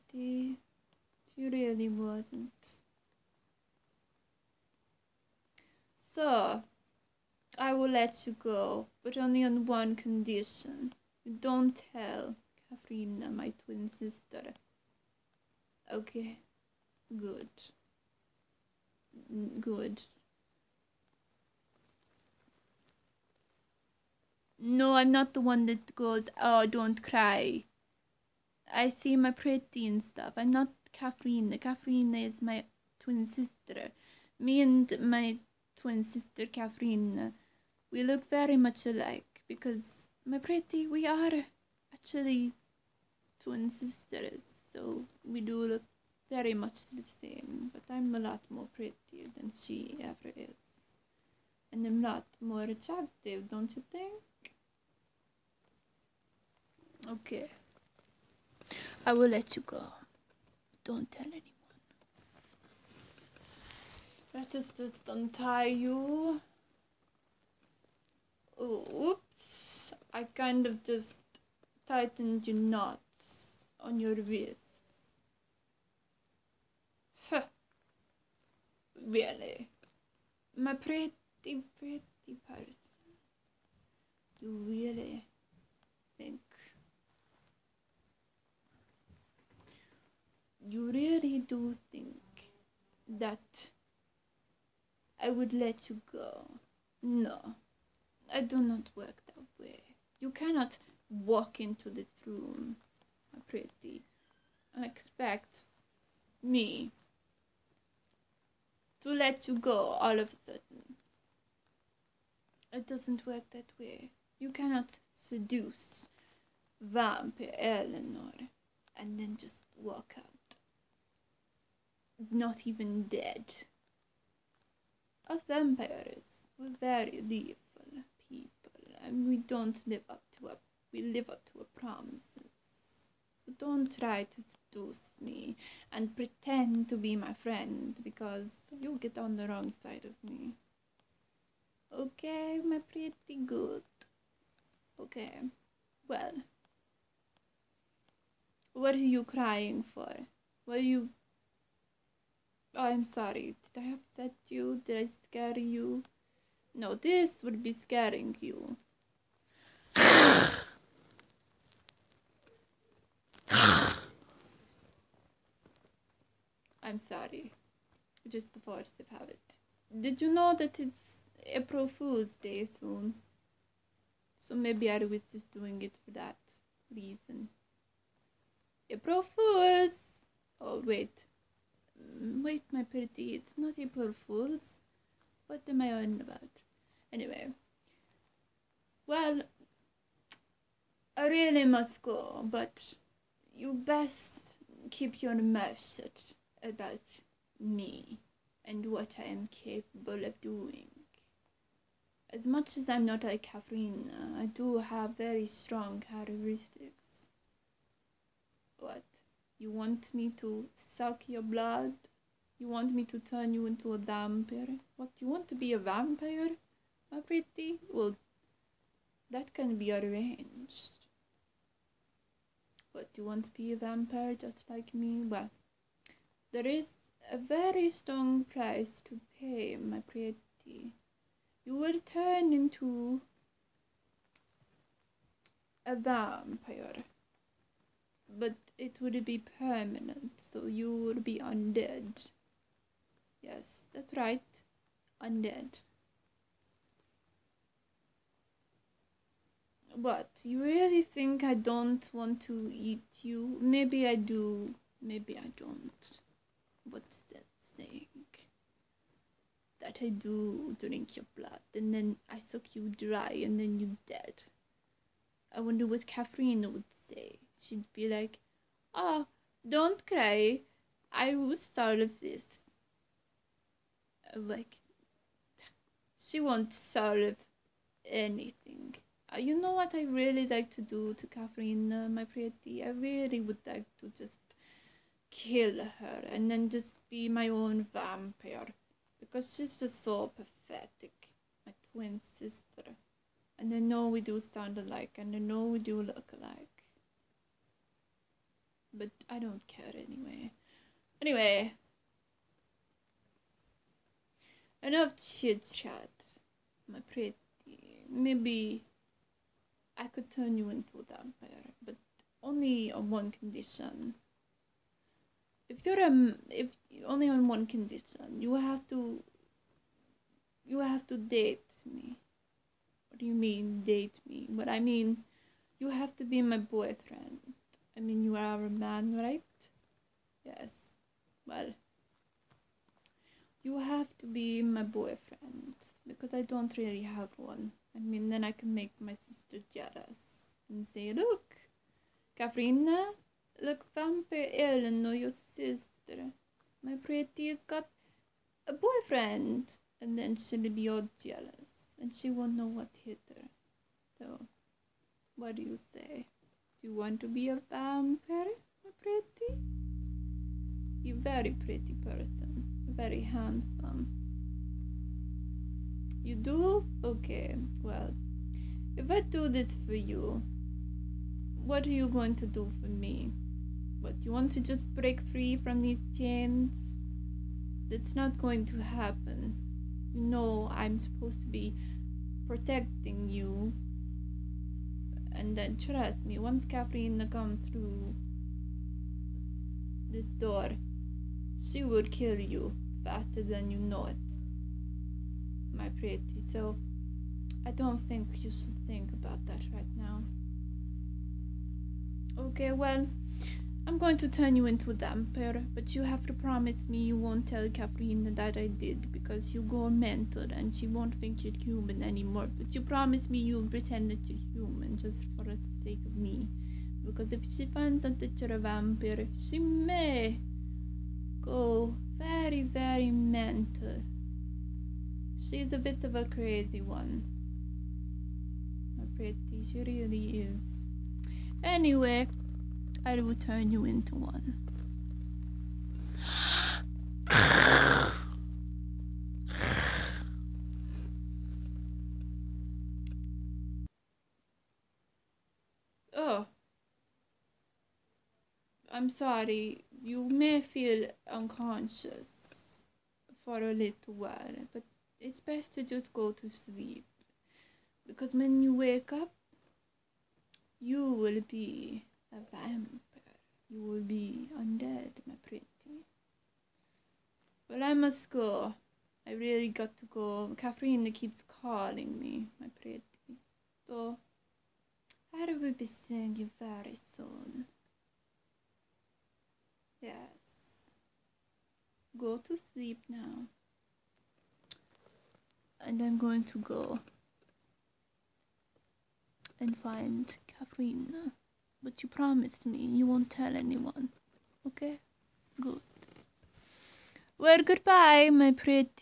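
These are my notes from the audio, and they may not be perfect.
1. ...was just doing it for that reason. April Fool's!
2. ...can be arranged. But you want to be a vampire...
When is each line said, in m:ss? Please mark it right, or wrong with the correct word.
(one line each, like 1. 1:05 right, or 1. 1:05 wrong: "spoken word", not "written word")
1. 2:54 right
2. 3:39 right.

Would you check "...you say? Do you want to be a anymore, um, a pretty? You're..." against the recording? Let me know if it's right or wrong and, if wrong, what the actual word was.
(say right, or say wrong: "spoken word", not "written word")
wrong: "vampire", not "anymore".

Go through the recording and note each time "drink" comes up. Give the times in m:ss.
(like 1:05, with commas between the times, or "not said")
4:20.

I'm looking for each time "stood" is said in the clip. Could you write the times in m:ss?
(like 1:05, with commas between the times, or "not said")
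not said.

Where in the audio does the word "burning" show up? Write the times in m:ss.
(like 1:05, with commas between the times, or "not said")
not said.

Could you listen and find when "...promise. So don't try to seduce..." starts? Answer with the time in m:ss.
2:11.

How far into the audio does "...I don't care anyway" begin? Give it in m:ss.
4:59.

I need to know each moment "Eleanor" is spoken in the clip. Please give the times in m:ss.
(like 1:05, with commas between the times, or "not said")
1:57, 5:44.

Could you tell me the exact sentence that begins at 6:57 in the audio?
Because if she finds out that you're a vampire, she may go very, very mental.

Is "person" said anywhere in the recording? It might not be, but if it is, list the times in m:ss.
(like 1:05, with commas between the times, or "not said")
1:22, 6:01.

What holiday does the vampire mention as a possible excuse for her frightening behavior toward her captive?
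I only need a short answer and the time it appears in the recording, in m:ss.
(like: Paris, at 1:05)
April Fool's Day, at 2:51.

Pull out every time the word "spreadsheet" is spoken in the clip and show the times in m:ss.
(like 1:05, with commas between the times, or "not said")
not said.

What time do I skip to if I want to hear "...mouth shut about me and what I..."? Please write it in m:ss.
3:15.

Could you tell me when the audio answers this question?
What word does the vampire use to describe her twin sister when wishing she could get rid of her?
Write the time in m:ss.
4:50.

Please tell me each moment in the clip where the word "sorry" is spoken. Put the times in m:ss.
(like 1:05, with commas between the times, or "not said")
2:33, 2:46, 7:29.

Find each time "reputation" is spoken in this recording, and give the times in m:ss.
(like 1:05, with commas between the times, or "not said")
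not said.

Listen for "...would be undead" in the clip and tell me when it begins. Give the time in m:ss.
4:00.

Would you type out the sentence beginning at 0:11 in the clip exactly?
You don't tell Katherina, my twin sister.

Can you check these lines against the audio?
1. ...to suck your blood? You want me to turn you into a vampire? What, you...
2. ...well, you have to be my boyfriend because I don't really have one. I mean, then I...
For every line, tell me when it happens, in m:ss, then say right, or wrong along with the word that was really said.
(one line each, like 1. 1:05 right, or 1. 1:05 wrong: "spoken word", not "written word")
1. 3:30 right
2. 5:31 right.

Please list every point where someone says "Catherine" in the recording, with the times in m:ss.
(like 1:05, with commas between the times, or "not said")
0:36, 4:26, 4:41, 6:26, 7:50, 8:10.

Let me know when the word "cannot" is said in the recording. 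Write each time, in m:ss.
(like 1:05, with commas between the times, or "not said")
1:40, 1:54.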